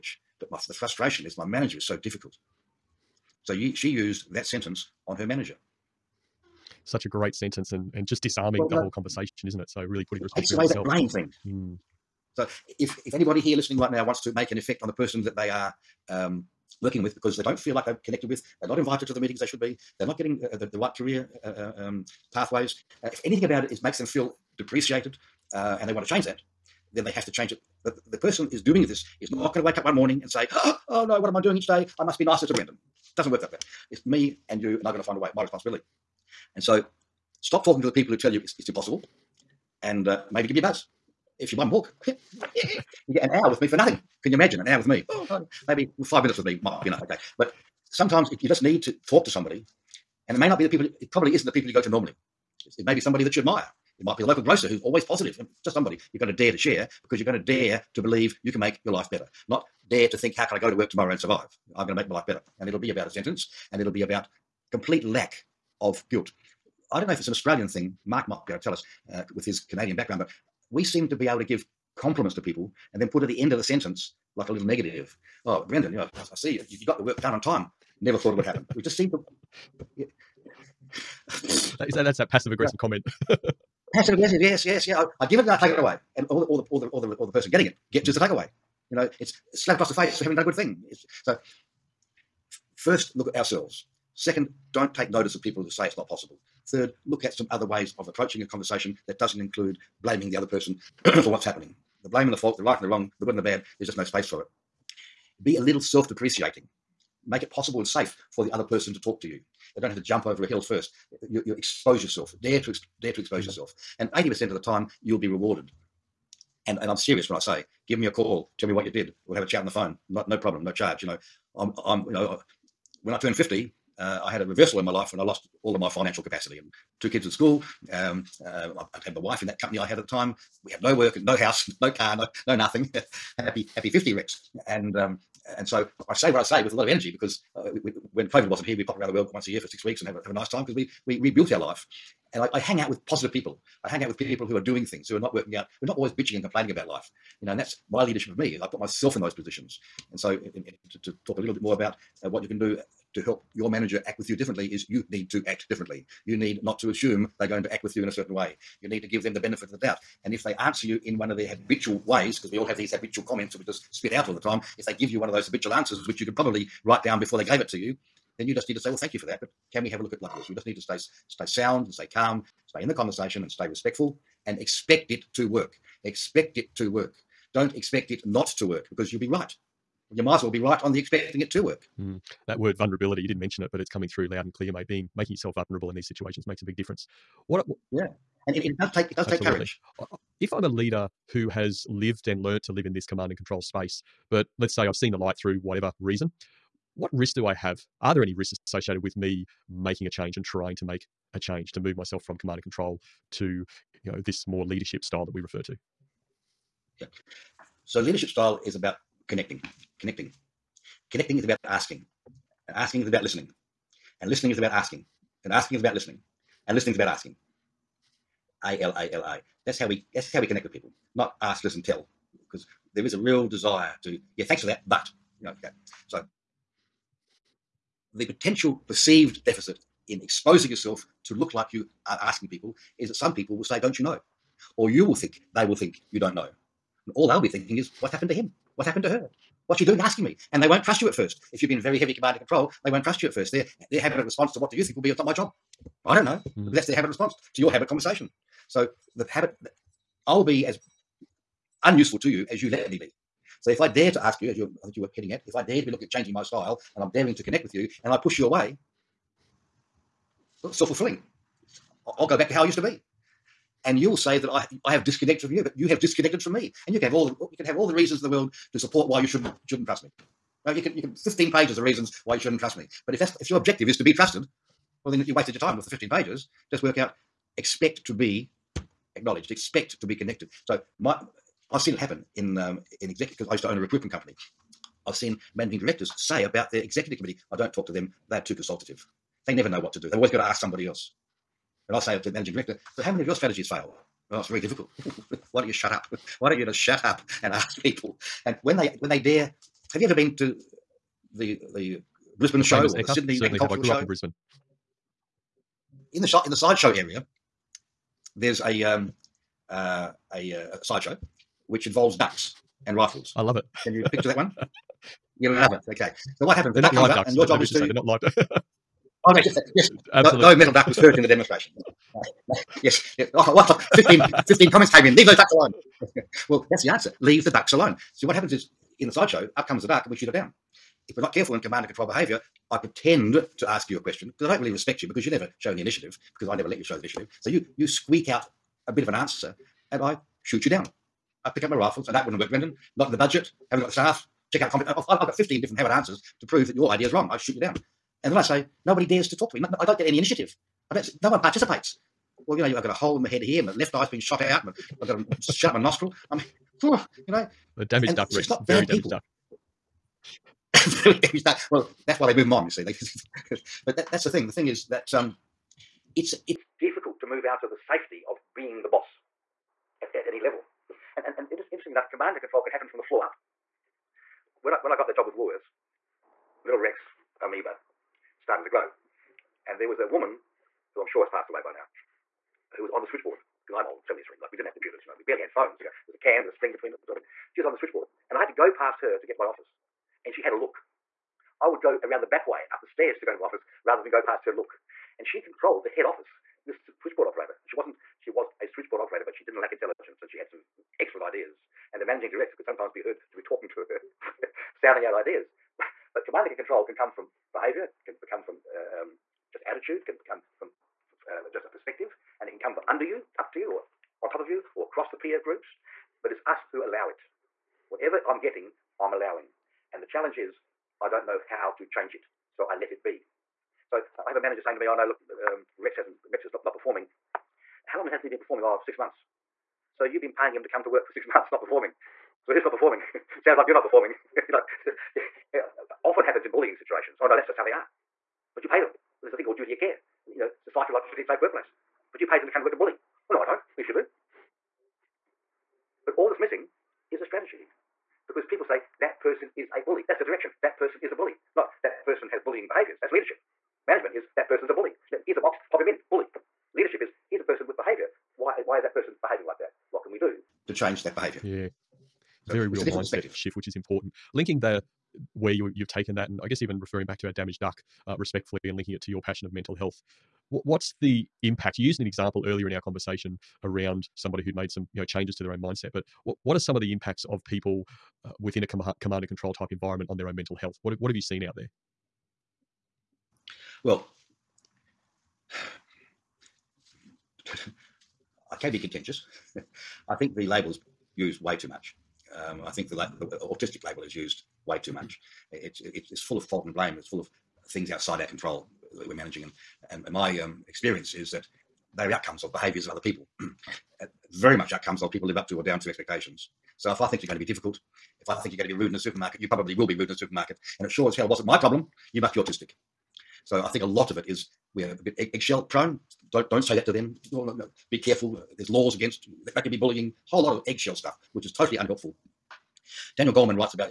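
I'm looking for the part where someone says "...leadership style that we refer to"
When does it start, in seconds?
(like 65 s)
204 s.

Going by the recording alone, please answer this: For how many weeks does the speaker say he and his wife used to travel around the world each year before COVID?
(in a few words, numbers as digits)
6.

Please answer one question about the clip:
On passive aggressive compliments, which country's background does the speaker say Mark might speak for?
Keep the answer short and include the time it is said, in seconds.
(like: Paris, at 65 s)
Canadian, at 69 s.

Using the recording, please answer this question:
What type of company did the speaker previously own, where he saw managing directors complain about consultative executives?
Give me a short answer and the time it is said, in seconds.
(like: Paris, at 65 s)
recruitment company, at 283 s.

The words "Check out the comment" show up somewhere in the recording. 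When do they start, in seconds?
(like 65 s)
344 s.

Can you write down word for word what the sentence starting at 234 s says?
Or you will think, they will think, You don't know.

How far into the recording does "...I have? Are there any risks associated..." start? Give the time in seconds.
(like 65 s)
197 s.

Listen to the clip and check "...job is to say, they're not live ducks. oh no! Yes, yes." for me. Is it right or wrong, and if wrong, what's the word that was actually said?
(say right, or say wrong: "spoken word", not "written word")
right.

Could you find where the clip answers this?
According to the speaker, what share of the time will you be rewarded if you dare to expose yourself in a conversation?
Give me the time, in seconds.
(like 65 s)
114 s.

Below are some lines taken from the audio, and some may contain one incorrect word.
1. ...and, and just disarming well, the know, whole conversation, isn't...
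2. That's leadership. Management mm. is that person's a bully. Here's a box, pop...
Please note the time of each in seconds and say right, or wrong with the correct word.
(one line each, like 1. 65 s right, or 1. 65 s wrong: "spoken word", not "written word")
1. 7 s right
2. 453 s right.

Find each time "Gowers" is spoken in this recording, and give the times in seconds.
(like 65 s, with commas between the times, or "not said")
not said.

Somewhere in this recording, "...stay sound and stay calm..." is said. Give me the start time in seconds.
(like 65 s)
171 s.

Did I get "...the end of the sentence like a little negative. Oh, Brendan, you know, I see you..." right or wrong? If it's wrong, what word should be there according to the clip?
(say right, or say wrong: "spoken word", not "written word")
right.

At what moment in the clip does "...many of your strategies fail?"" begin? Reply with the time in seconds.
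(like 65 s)
293 s.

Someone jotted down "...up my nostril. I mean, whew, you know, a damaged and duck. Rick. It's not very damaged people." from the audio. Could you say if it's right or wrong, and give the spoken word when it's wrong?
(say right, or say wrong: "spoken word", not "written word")
right.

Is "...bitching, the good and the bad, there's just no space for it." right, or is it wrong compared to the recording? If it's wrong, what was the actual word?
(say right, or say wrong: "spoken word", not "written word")
wrong: "wrong", not "bitching".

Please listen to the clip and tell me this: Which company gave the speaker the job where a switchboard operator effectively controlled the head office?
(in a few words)
Woolworths.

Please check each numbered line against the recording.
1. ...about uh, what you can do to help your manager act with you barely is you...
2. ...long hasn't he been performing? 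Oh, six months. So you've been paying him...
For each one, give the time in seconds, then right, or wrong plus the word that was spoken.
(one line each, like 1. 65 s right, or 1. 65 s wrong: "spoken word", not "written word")
1. 151 s wrong: "differently", not "barely"
2. 427 s right.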